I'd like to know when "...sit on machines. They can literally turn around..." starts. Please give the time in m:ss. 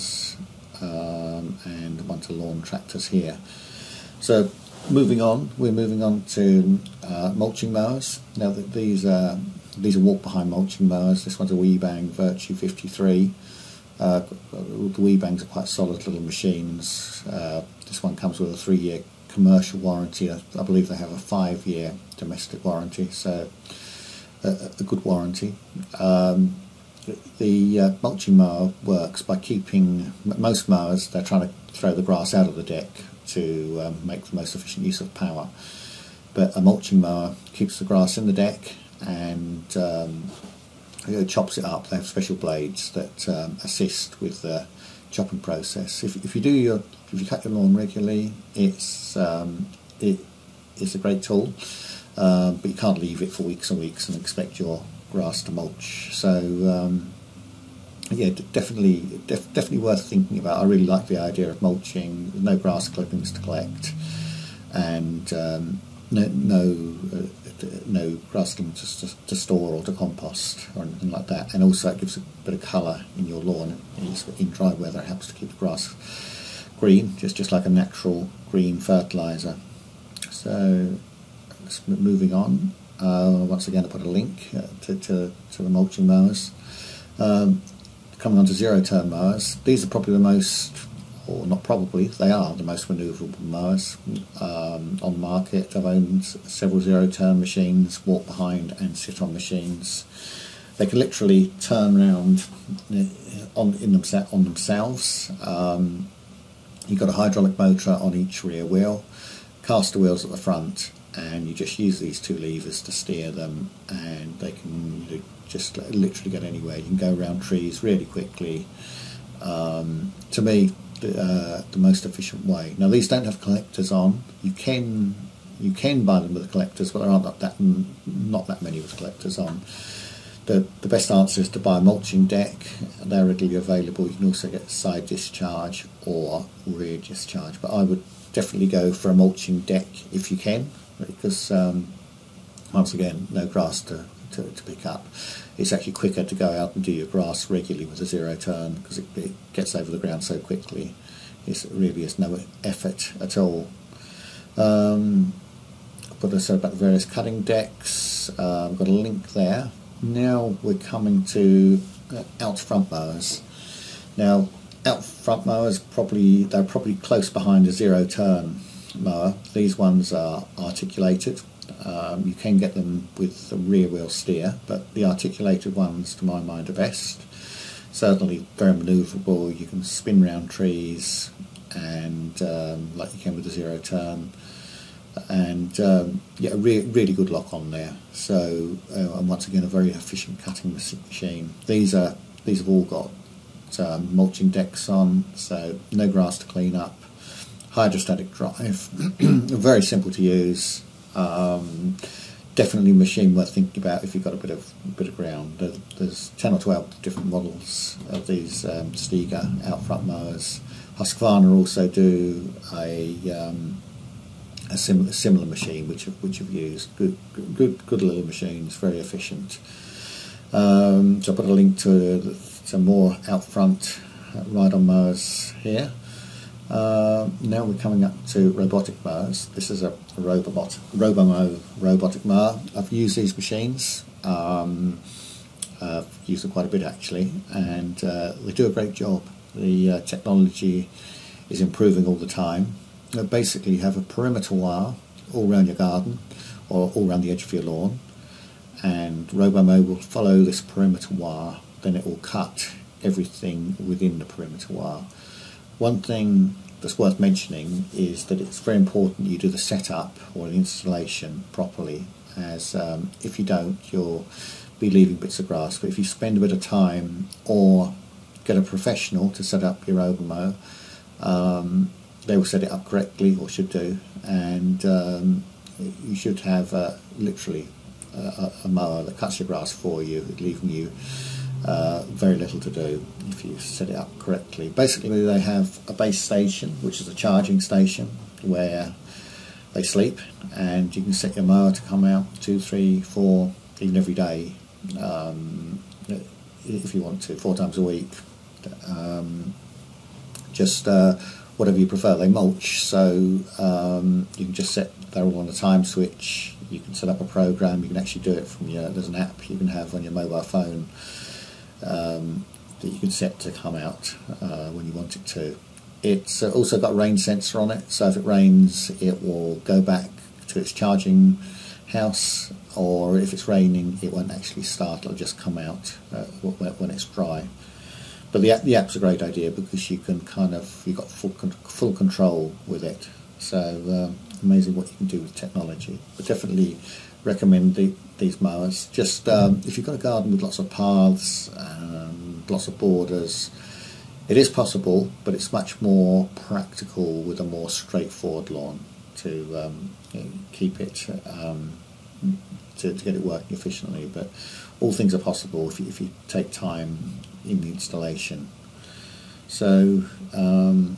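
1:38.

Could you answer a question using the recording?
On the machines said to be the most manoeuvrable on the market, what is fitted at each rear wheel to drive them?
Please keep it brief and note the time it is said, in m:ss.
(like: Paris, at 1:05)
hydraulic motor, at 1:47.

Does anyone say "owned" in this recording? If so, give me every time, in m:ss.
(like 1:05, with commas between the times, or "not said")
1:35.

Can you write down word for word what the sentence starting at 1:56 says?
You can go around trees really quickly.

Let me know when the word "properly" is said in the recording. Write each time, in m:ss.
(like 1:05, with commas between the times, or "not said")
4:21.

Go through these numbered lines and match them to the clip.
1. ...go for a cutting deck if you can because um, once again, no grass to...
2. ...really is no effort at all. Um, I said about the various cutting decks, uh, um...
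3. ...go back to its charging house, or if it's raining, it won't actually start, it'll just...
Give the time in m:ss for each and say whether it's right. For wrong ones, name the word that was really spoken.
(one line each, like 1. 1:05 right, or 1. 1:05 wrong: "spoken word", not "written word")
1. 2:18 wrong: "mulching", not "cutting"
2. 2:31 right
3. 5:19 right.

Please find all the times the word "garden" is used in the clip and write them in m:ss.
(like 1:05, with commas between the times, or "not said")
4:05, 5:39.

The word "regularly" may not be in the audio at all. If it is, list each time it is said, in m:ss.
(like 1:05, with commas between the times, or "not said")
0:47, 2:27.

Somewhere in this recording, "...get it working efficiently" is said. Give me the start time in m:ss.
5:53.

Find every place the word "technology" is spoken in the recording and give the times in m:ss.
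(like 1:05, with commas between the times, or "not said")
4:00, 5:35.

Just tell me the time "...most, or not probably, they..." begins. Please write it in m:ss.
1:30.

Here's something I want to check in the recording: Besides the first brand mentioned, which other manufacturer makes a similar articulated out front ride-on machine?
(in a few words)
Husqvarna.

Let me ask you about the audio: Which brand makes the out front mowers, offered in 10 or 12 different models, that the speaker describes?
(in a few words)
Stiga.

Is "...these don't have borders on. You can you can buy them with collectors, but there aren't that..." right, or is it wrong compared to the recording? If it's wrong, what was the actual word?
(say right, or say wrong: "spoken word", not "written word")
wrong: "collectors", not "borders".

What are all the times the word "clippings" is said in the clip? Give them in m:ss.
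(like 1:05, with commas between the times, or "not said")
1:02, 1:08.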